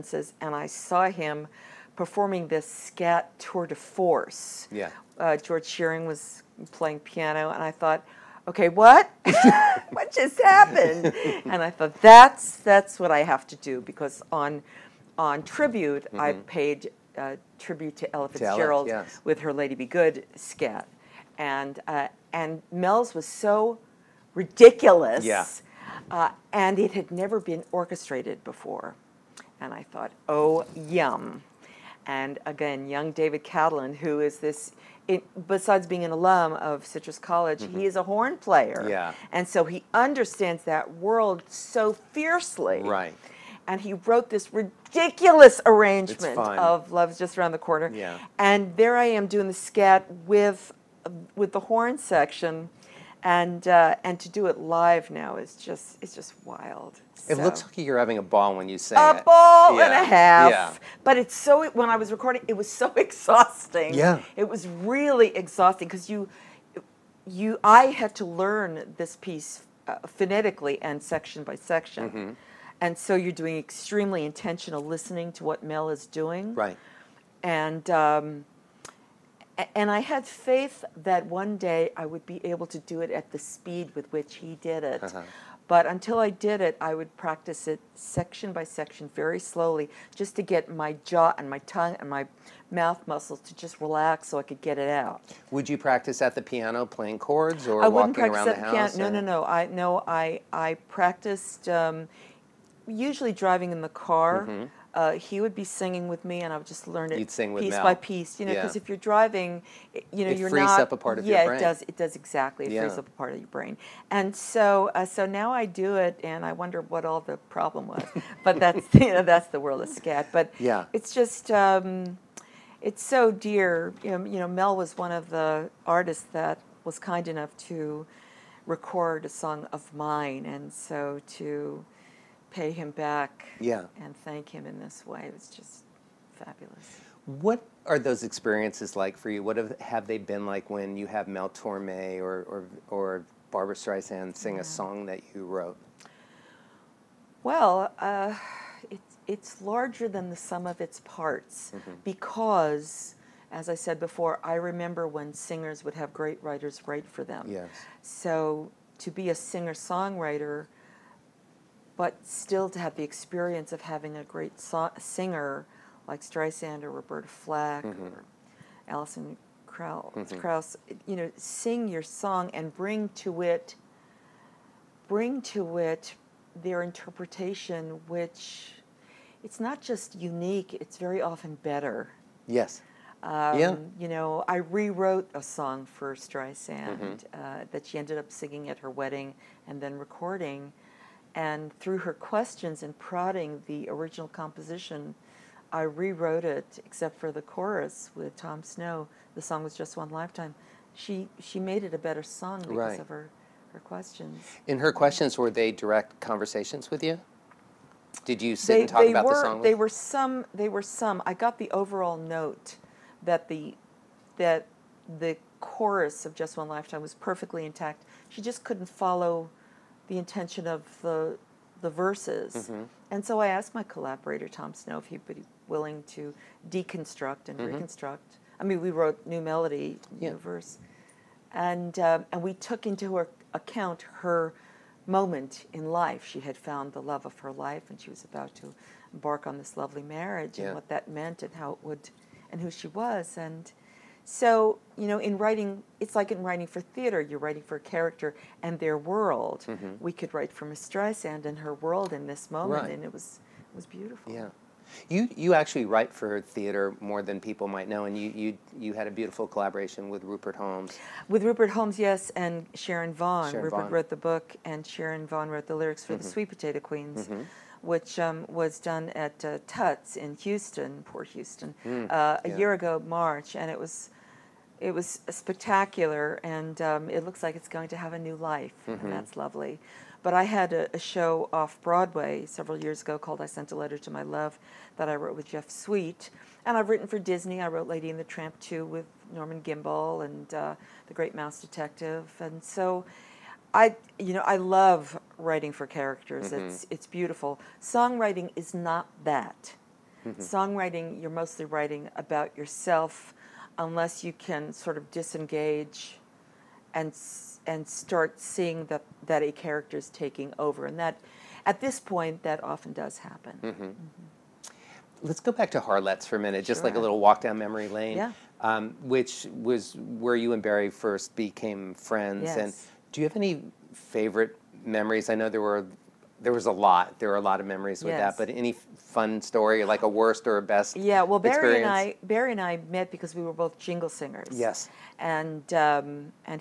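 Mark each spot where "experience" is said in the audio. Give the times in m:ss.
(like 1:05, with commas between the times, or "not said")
2:18, 2:43, 5:31.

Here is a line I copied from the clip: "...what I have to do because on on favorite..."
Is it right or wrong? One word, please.
wrong.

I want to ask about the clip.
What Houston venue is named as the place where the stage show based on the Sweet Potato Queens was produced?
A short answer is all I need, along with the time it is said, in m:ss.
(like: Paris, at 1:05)
Tuts, at 4:29.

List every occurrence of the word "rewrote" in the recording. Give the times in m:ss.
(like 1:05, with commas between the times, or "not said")
3:04, 3:15.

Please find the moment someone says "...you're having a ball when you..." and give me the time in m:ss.
0:57.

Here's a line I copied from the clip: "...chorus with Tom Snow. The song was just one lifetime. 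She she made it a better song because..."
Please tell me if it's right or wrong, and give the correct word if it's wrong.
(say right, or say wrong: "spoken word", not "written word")
right.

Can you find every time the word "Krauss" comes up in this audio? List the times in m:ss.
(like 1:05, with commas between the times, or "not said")
2:49.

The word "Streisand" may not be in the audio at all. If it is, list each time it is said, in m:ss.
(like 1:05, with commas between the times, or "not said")
2:23, 2:46, 3:06, 4:10.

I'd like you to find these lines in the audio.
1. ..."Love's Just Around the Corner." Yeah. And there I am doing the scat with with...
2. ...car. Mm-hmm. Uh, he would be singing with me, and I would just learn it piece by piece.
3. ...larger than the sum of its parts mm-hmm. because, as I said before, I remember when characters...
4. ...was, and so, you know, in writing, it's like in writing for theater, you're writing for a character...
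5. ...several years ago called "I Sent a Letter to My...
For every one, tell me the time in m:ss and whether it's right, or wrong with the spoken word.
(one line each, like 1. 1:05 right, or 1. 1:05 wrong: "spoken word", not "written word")
1. 0:46 right
2. 1:43 right
3. 2:29 wrong: "singers", not "characters"
4. 4:02 right
5. 4:42 right.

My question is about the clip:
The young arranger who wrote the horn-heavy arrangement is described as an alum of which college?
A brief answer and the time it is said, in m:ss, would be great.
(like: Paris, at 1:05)
Citrus College, at 0:36.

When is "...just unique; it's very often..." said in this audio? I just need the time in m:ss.
2:59.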